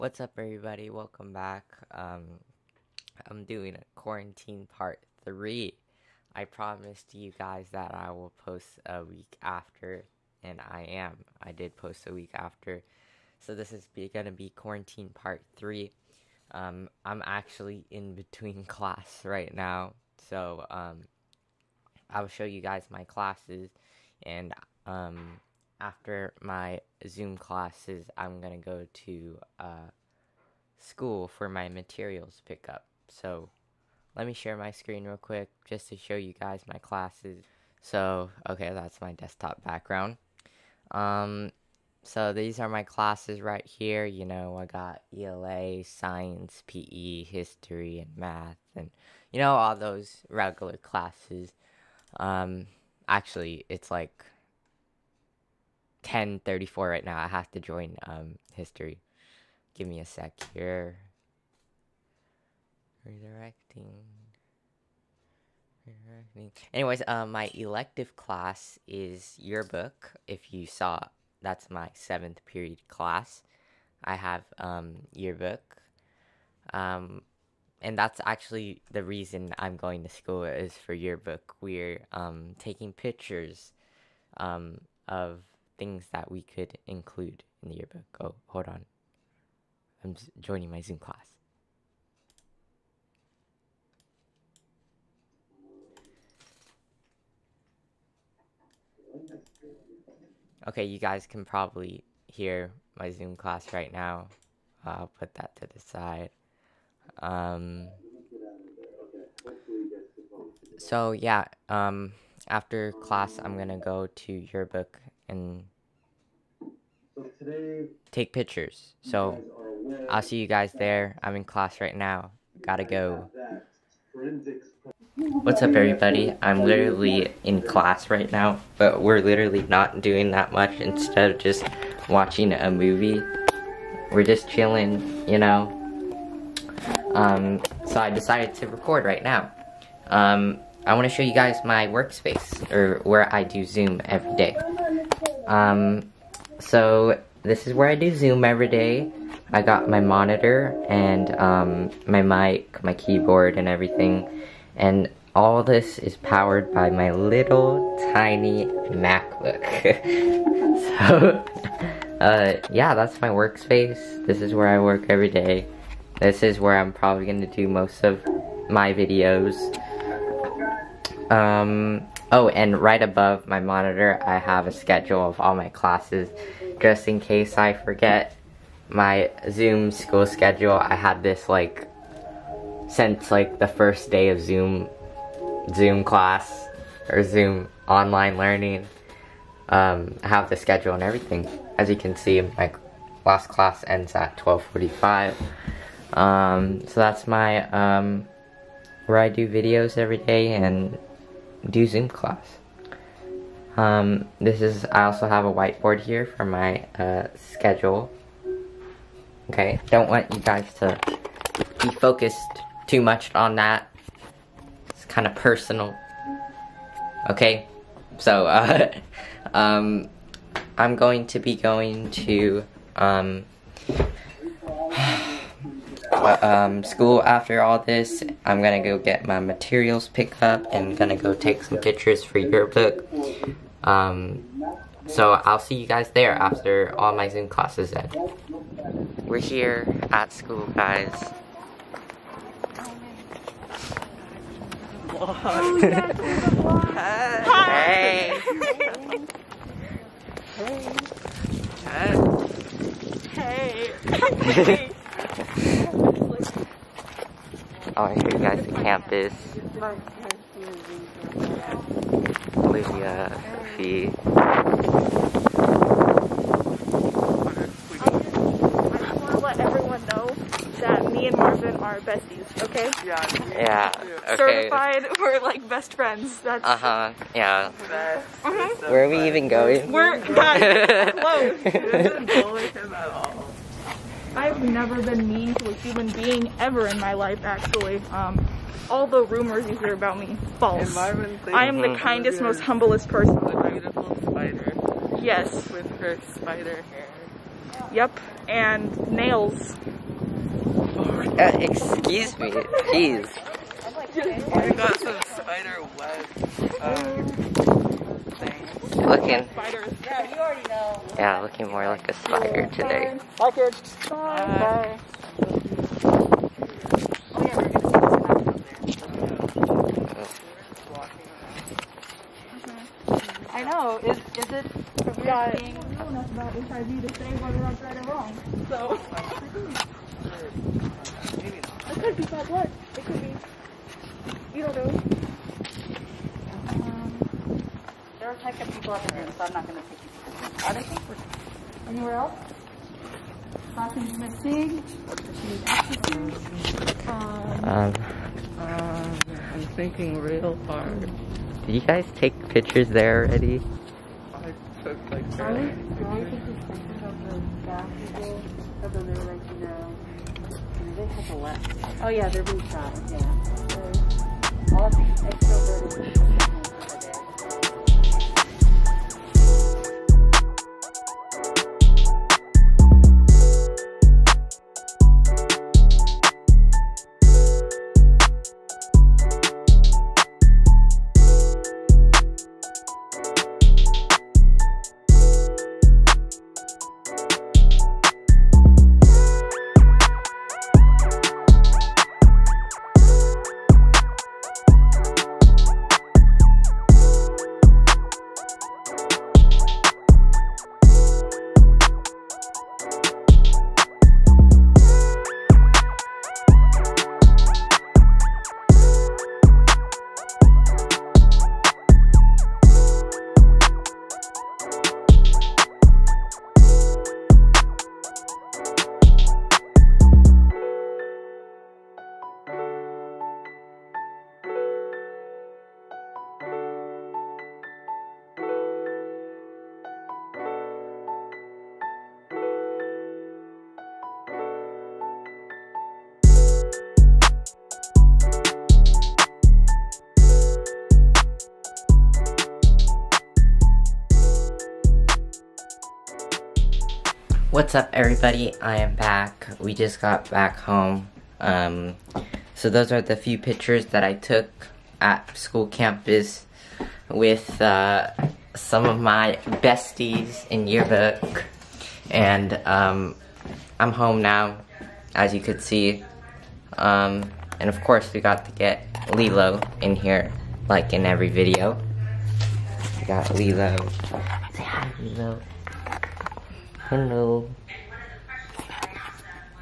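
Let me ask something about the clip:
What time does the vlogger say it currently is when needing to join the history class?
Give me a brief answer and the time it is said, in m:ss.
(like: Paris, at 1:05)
10:34, at 0:56.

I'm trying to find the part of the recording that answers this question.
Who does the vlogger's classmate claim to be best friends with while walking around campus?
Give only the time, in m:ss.
4:31.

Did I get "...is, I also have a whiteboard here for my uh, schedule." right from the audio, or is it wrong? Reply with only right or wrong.
right.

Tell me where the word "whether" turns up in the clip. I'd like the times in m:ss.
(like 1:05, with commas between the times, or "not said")
5:27.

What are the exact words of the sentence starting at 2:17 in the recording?
Um, so I decided to record right now.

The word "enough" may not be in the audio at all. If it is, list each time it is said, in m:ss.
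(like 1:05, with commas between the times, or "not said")
5:25.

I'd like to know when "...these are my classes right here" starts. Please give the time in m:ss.
0:42.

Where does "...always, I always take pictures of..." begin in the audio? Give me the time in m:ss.
5:55.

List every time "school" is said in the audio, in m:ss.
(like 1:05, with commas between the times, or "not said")
0:30, 1:20, 2:59, 3:46, 4:00, 7:35.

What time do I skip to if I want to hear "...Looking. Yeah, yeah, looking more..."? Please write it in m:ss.
5:08.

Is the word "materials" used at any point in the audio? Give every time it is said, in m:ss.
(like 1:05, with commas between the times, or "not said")
0:31, 3:49.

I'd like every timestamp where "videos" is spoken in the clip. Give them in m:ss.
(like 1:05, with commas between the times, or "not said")
2:48, 3:19, 7:51.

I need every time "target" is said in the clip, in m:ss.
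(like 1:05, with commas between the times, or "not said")
not said.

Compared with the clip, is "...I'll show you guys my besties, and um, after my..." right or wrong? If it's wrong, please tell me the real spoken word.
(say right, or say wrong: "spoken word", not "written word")
wrong: "classes", not "besties".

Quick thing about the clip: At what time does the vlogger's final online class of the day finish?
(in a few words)
12:45.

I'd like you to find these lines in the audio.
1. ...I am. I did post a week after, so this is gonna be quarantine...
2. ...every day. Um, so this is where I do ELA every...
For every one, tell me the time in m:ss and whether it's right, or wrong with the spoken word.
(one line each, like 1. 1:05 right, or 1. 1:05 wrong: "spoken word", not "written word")
1. 0:10 right
2. 2:24 wrong: "Zoom", not "ELA".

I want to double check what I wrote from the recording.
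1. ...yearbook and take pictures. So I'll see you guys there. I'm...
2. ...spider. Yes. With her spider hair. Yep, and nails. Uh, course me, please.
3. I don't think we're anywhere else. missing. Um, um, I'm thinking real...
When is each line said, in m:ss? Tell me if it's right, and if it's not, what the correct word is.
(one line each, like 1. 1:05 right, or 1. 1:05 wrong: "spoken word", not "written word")
1. 1:54 right
2. 4:54 wrong: "excuse", not "course"
3. 5:40 right.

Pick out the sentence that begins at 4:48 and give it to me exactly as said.
Um, all the rumors you hear about me, false.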